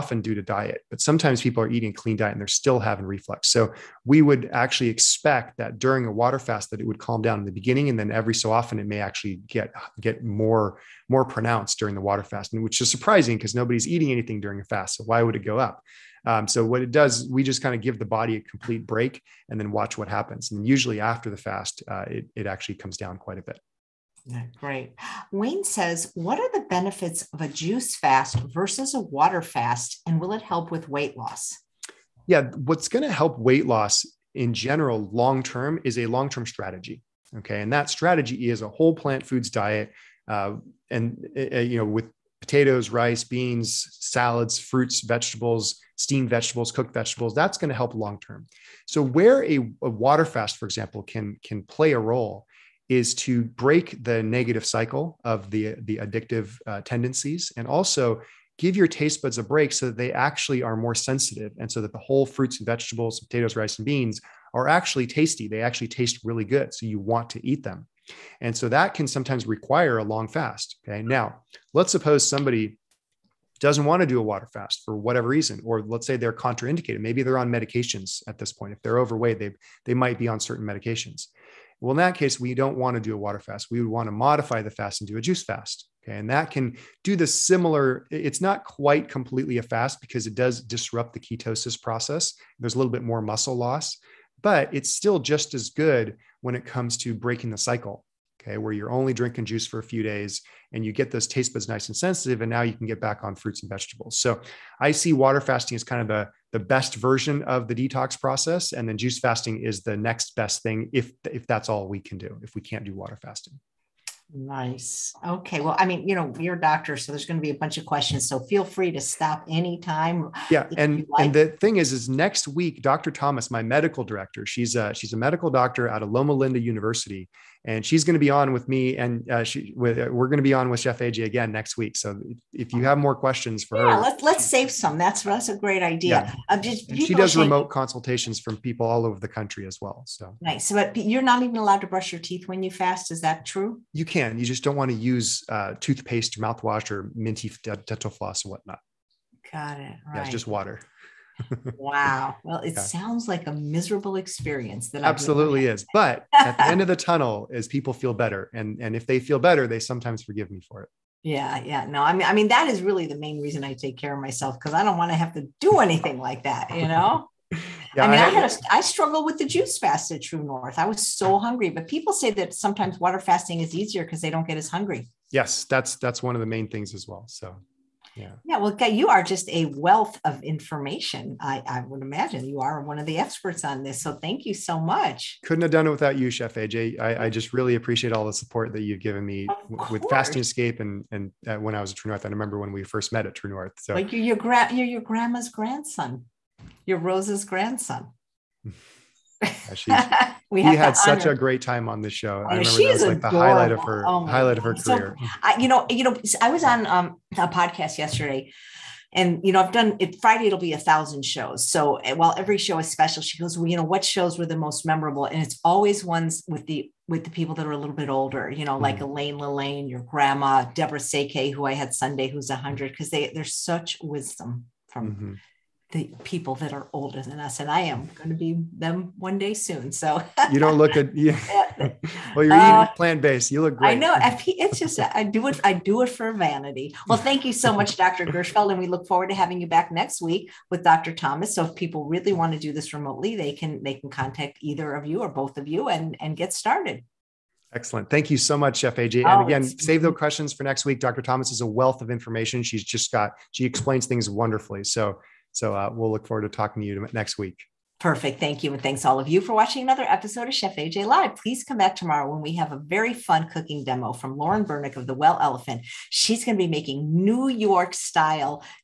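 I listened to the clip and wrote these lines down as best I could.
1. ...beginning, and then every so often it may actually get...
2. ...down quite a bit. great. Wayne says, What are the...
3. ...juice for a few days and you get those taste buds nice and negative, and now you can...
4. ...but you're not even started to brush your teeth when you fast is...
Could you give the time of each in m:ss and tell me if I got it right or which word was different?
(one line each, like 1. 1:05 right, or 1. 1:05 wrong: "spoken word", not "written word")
1. 0:07 right
2. 0:22 right
3. 1:39 wrong: "sensitive", not "negative"
4. 2:20 wrong: "allowed", not "started".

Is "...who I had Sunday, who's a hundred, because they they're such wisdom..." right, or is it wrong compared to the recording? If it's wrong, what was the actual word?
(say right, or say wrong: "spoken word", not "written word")
right.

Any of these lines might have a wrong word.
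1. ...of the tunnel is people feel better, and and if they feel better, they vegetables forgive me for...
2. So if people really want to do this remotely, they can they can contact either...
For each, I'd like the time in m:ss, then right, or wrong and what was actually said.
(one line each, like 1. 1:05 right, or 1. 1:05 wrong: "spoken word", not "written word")
1. 2:36 wrong: "sometimes", not "vegetables"
2. 4:01 right.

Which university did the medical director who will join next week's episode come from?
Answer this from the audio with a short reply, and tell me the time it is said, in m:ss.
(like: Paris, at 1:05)
Loma Linda University, at 2:06.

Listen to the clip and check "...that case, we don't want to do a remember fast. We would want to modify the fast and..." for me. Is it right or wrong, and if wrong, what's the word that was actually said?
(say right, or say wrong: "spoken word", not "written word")
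wrong: "water", not "remember".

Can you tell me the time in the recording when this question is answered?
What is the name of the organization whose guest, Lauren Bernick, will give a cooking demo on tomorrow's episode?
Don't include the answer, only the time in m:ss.
4:25.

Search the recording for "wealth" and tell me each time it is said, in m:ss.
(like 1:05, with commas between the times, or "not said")
2:59, 4:11.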